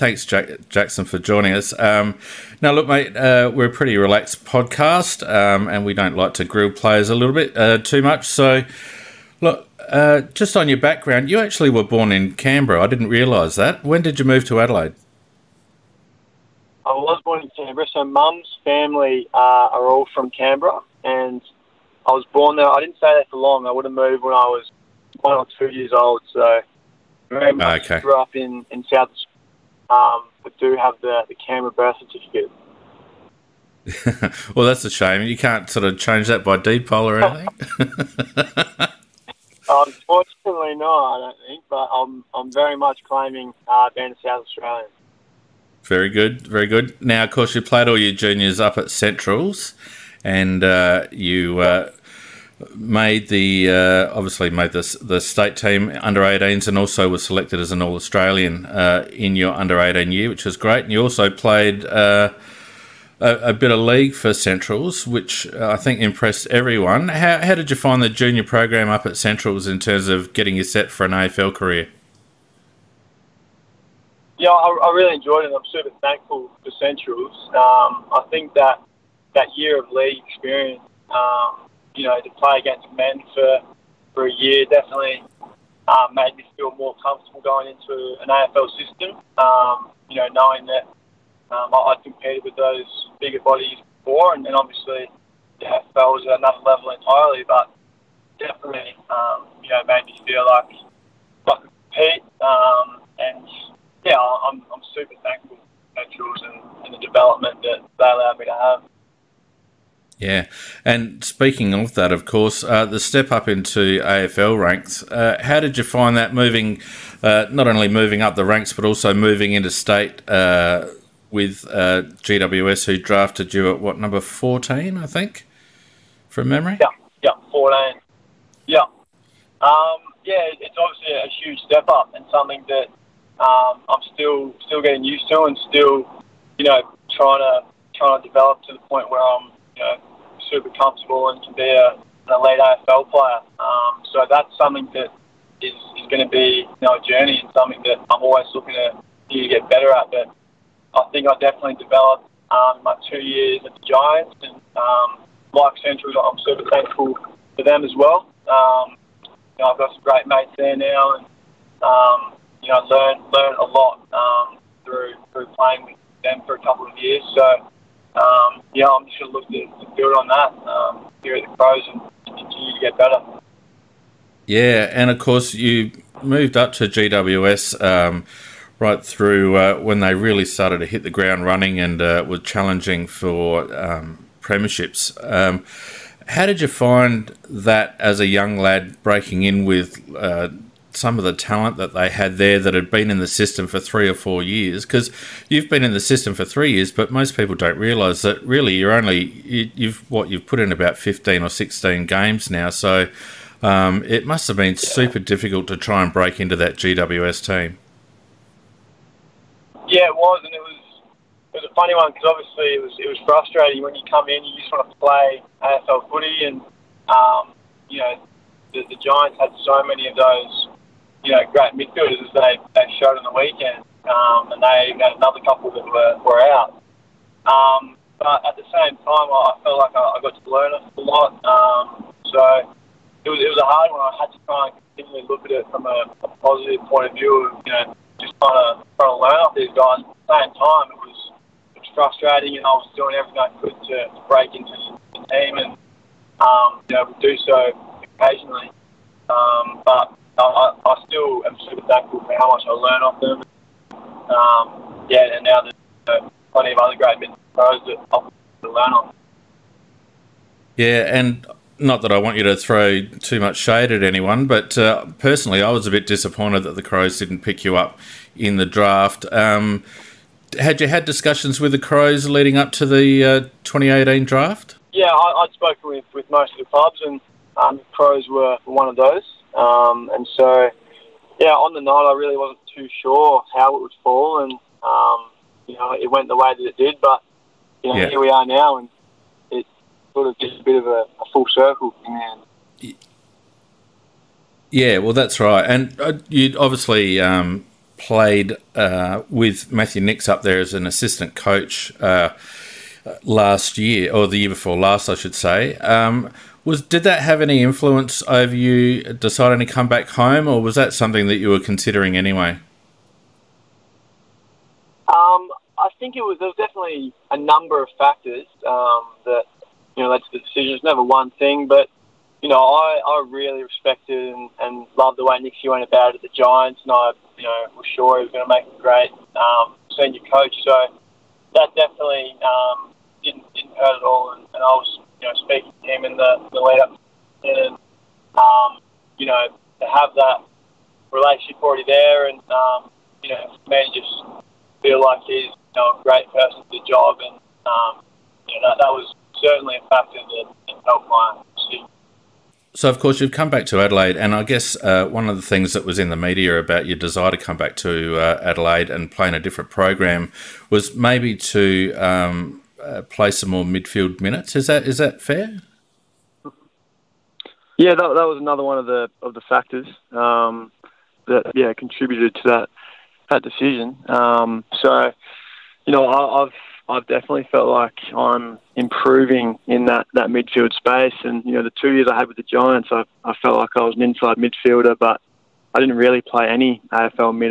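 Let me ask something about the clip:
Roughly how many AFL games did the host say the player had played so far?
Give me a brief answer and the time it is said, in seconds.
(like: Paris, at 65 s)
15 or 16, at 200 s.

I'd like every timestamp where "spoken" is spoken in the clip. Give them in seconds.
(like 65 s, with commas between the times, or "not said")
275 s.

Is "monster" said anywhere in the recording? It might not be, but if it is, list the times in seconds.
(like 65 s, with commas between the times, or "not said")
not said.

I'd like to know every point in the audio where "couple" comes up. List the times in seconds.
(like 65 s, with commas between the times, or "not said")
166 s, 225 s.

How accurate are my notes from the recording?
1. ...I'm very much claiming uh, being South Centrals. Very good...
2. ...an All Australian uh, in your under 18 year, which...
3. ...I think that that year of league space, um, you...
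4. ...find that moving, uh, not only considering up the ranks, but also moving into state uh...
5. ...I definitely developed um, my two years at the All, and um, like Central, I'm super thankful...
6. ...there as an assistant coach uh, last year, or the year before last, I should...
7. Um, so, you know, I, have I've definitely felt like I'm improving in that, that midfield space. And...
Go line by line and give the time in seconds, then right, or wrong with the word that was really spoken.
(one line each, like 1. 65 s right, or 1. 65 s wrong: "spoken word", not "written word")
1. 42 s wrong: "Australian", not "Centrals"
2. 57 s right
3. 78 s wrong: "experience", not "space"
4. 115 s wrong: "moving", not "considering"
5. 151 s wrong: "Giants", not "All"
6. 300 s right
7. 374 s right.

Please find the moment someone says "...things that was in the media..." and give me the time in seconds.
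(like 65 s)
355 s.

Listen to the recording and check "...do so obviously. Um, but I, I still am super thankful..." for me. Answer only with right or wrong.
wrong.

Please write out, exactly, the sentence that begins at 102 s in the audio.
Um, and yeah, I'm, I'm super thankful for Naturals and, and the development that they allowed me to have.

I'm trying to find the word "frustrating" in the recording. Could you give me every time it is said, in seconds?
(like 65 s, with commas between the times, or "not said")
213 s, 241 s.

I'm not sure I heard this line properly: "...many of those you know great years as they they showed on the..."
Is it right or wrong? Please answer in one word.
wrong.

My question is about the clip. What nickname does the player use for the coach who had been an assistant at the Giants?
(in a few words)
Nixie.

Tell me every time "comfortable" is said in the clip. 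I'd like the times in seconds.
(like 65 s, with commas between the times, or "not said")
87 s, 140 s.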